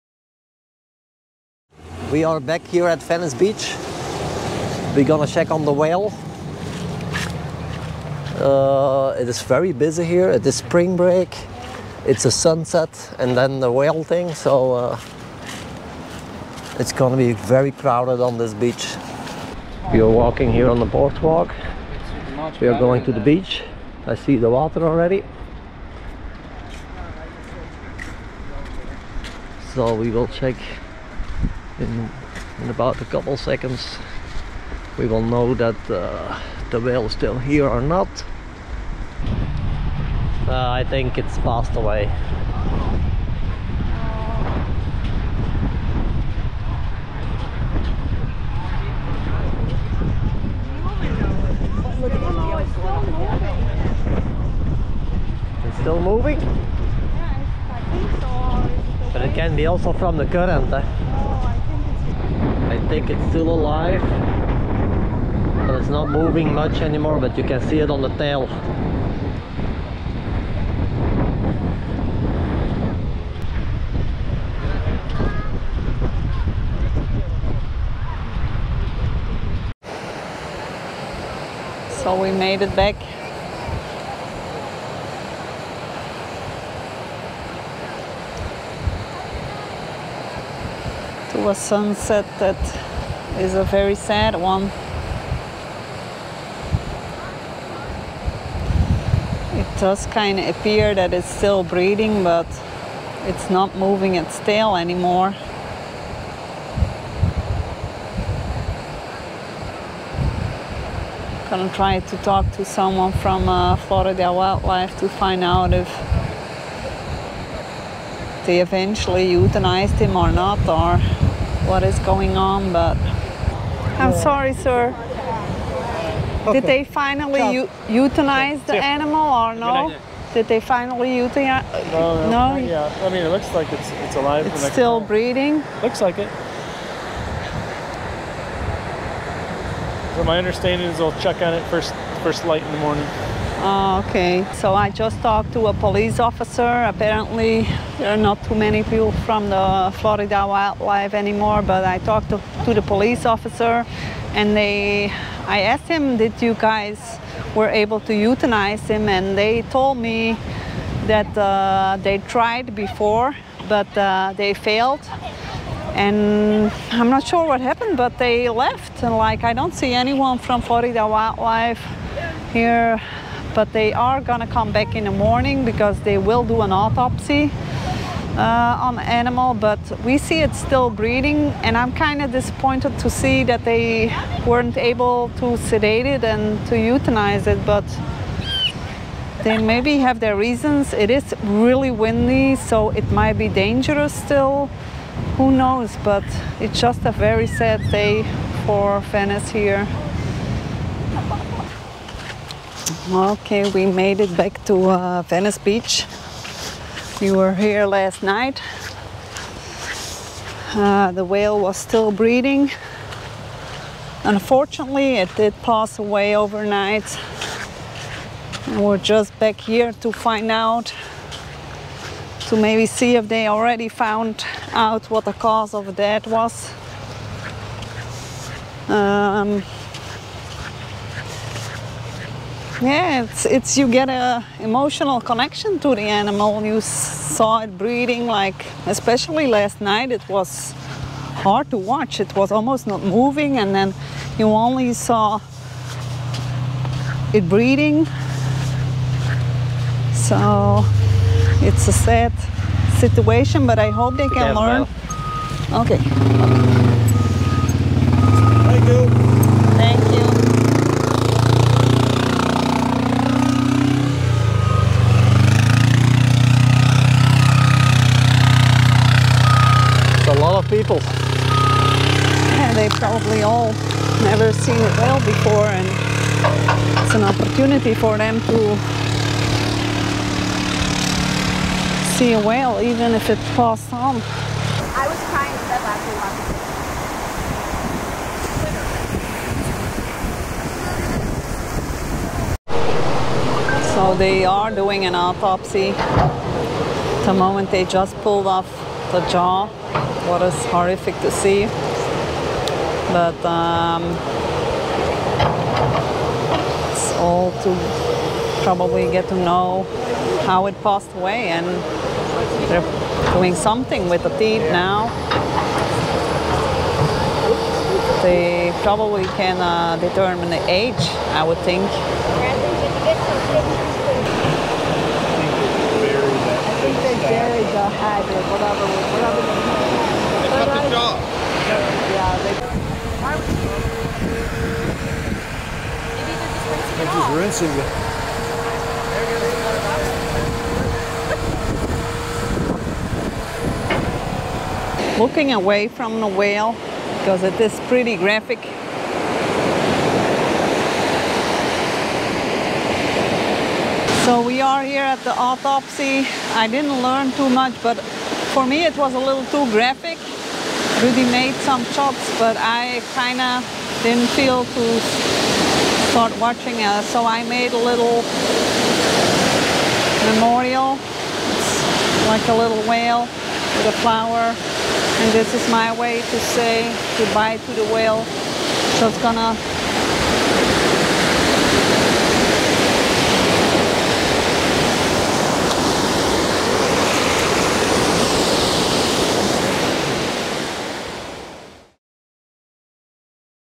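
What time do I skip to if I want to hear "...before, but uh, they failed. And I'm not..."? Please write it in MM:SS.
02:42.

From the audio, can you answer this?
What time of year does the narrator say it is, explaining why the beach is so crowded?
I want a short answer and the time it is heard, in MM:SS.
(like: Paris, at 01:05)
Spring break, at 00:10.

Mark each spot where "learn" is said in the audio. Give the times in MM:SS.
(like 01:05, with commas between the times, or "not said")
04:14, 05:57.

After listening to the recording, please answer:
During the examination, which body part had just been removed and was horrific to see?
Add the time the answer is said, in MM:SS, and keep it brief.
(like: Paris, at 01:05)
The jaw, at 04:59.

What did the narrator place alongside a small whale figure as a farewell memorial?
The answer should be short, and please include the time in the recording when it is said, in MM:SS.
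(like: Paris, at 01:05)
A flower, at 06:13.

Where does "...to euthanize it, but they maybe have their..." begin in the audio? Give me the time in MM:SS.
03:06.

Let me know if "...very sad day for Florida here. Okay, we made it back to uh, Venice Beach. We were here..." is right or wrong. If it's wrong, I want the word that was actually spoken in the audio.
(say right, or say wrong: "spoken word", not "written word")
wrong: "Venice", not "Florida".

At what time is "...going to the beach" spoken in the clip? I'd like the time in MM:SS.
00:22.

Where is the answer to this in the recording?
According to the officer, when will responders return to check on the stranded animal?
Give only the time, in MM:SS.
02:22.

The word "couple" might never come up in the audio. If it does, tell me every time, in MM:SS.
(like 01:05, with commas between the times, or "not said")
00:33.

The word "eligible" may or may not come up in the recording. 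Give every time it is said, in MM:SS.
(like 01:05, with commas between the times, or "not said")
not said.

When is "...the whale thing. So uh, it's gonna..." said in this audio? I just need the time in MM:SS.
00:13.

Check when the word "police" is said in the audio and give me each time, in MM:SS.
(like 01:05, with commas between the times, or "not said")
02:25, 02:32.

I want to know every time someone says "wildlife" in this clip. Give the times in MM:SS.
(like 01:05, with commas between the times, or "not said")
01:54, 02:30, 02:51.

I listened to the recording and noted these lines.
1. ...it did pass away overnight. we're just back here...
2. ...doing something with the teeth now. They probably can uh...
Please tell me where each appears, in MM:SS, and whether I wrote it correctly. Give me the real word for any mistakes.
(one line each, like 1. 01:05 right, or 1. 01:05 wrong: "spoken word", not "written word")
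1. 03:35 right
2. 05:13 right.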